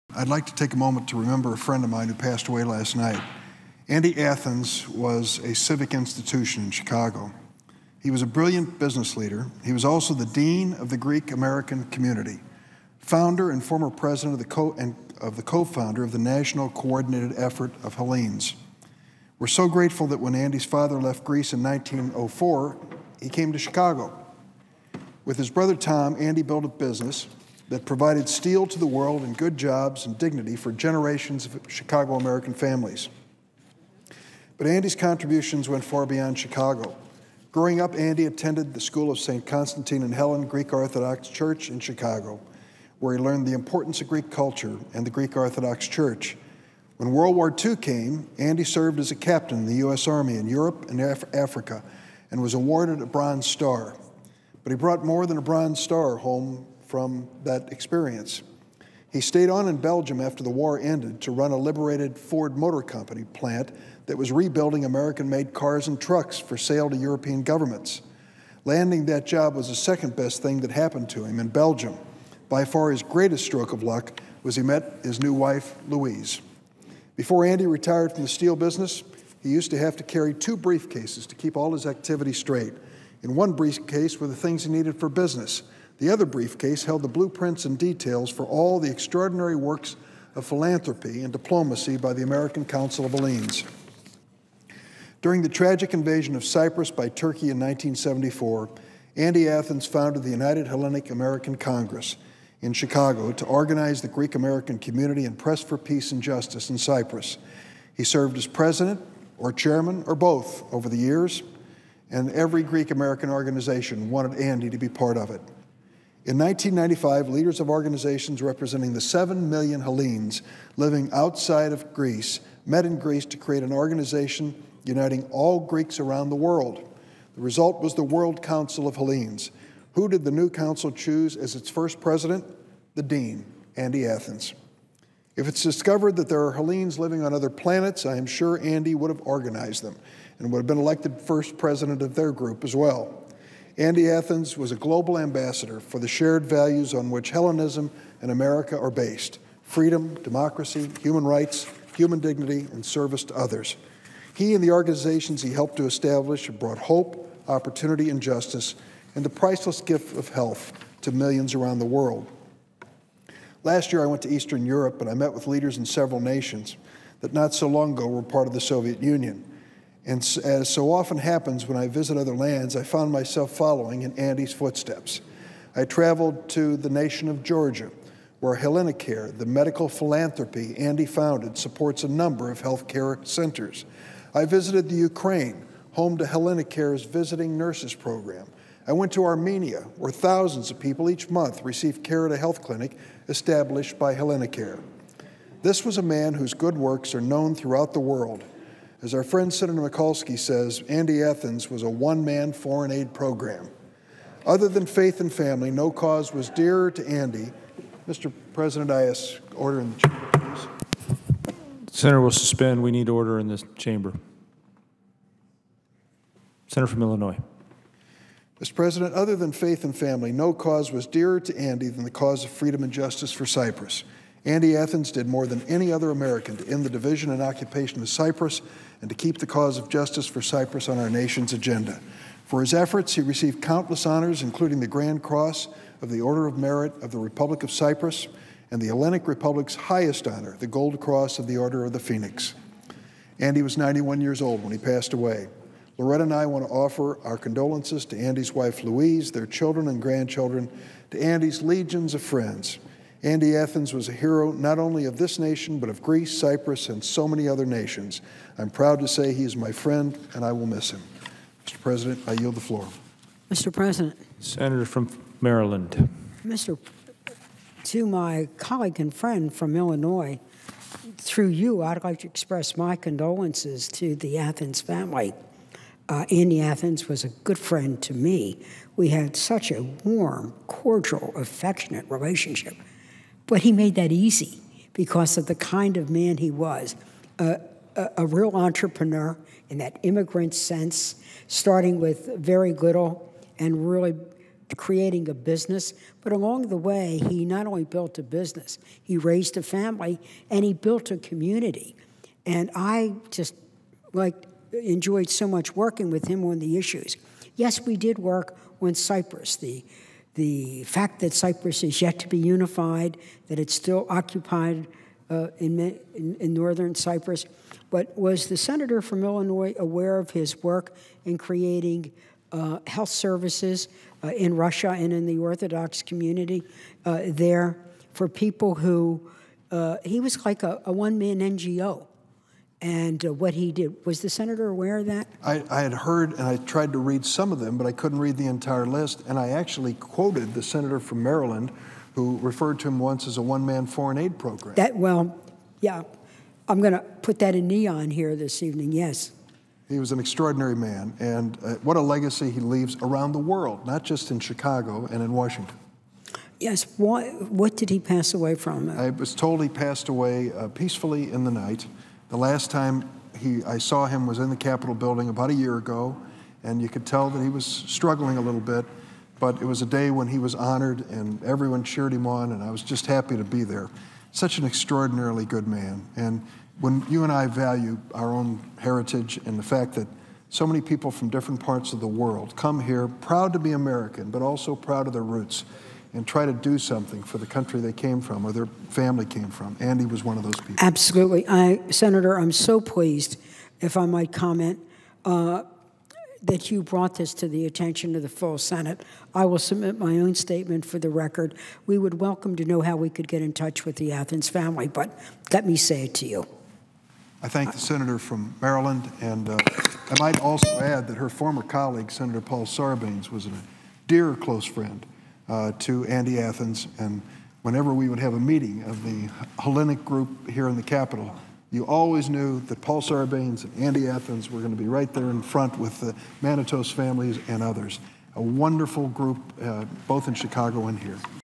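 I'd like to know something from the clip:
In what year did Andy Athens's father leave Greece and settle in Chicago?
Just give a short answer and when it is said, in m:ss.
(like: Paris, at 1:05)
1904, at 0:21.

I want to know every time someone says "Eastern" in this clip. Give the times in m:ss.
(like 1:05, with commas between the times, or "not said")
2:44.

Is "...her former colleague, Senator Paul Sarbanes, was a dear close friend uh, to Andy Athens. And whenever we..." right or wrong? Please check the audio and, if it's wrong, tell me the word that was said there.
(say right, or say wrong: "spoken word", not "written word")
right.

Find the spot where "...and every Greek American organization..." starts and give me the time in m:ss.
1:52.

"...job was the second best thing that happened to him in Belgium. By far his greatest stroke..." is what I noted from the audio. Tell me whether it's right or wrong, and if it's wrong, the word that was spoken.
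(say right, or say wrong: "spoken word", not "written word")
right.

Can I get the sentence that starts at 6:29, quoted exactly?
Andy was one of those people.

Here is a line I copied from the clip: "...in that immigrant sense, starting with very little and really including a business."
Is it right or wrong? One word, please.
wrong.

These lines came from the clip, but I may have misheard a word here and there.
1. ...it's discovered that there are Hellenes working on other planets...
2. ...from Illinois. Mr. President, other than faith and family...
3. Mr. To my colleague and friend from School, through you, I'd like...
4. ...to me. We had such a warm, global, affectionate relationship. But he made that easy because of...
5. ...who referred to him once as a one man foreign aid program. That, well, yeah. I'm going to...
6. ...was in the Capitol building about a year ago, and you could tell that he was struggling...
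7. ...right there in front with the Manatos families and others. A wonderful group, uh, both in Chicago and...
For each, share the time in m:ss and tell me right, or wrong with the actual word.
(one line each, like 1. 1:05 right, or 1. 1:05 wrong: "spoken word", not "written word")
1. 2:15 wrong: "living", not "working"
2. 3:36 right
3. 4:26 wrong: "Illinois", not "School"
4. 4:38 wrong: "cordial", not "global"
5. 5:42 right
6. 6:04 right
7. 7:04 right.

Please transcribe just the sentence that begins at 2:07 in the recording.
The result was the World Council of Hellenes.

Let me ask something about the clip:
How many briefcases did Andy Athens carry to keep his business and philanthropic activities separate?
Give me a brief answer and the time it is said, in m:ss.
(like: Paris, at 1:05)
2, at 1:20.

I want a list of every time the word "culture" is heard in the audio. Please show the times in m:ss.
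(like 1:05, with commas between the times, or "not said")
0:44.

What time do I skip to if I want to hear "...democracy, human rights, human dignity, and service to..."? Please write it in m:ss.
2:30.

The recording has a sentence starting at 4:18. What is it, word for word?
I'm proud to say he is my friend, and I will miss him.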